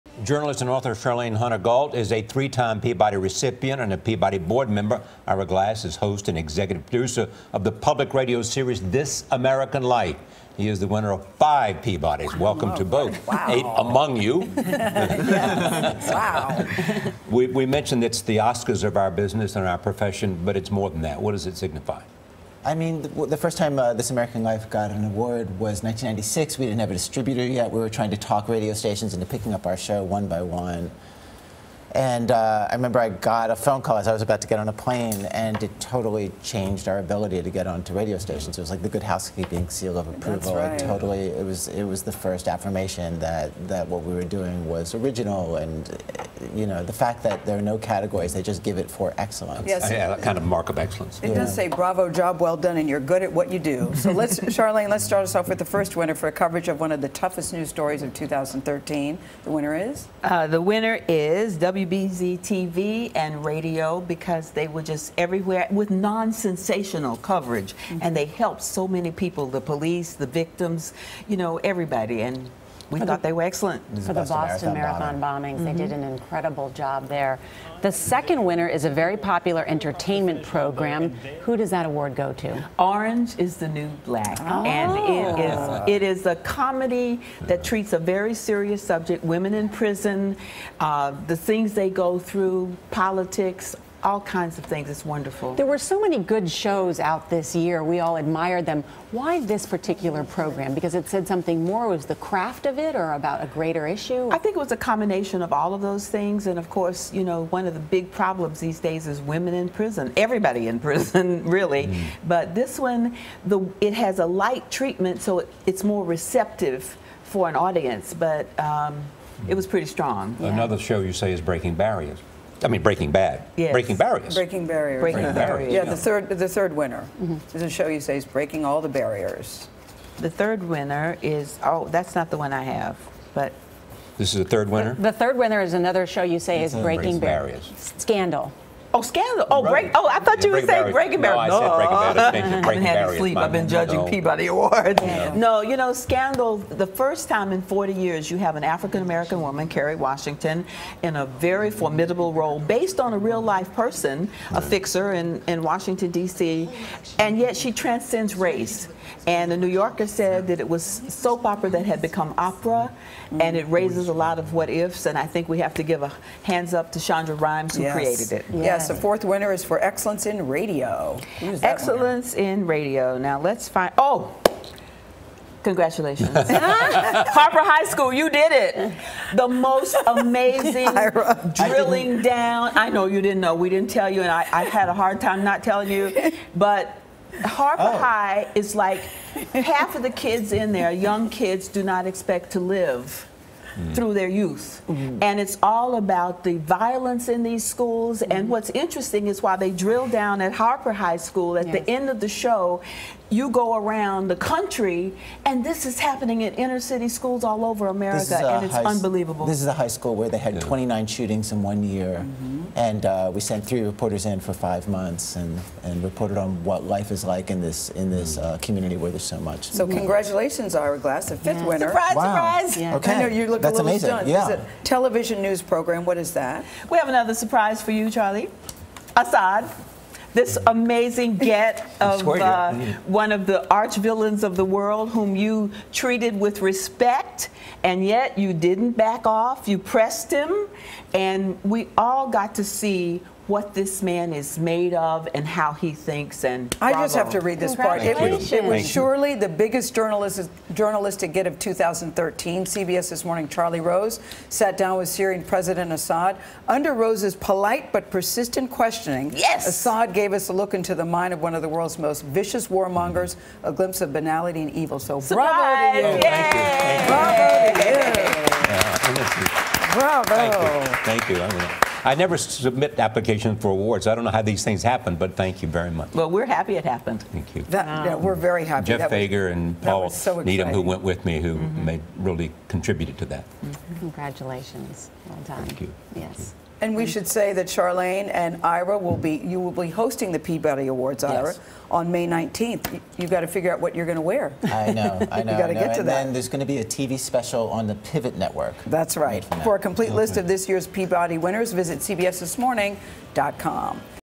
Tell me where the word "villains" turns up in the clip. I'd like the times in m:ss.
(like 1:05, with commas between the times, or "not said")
3:53.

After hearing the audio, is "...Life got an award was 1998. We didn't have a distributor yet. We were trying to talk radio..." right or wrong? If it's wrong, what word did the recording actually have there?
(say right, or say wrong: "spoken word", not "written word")
wrong: "1996", not "1998".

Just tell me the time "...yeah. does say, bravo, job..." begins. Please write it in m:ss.
0:51.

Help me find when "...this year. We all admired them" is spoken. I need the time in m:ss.
1:37.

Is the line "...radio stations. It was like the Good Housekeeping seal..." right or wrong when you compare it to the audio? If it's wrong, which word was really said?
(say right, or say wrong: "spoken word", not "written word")
right.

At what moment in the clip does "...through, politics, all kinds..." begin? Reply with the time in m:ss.
1:32.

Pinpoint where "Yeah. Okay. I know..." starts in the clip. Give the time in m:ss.
3:42.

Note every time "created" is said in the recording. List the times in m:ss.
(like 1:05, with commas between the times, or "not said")
2:47.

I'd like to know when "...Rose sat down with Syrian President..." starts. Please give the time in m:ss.
4:13.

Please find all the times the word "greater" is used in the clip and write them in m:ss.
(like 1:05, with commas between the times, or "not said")
1:43.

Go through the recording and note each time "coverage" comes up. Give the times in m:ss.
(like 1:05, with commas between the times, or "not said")
0:56, 1:07.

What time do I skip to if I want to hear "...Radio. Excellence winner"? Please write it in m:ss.
2:50.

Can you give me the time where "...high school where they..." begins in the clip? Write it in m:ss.
3:29.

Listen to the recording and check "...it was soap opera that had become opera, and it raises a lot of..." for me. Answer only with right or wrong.
right.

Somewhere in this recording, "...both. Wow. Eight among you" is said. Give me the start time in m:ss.
0:12.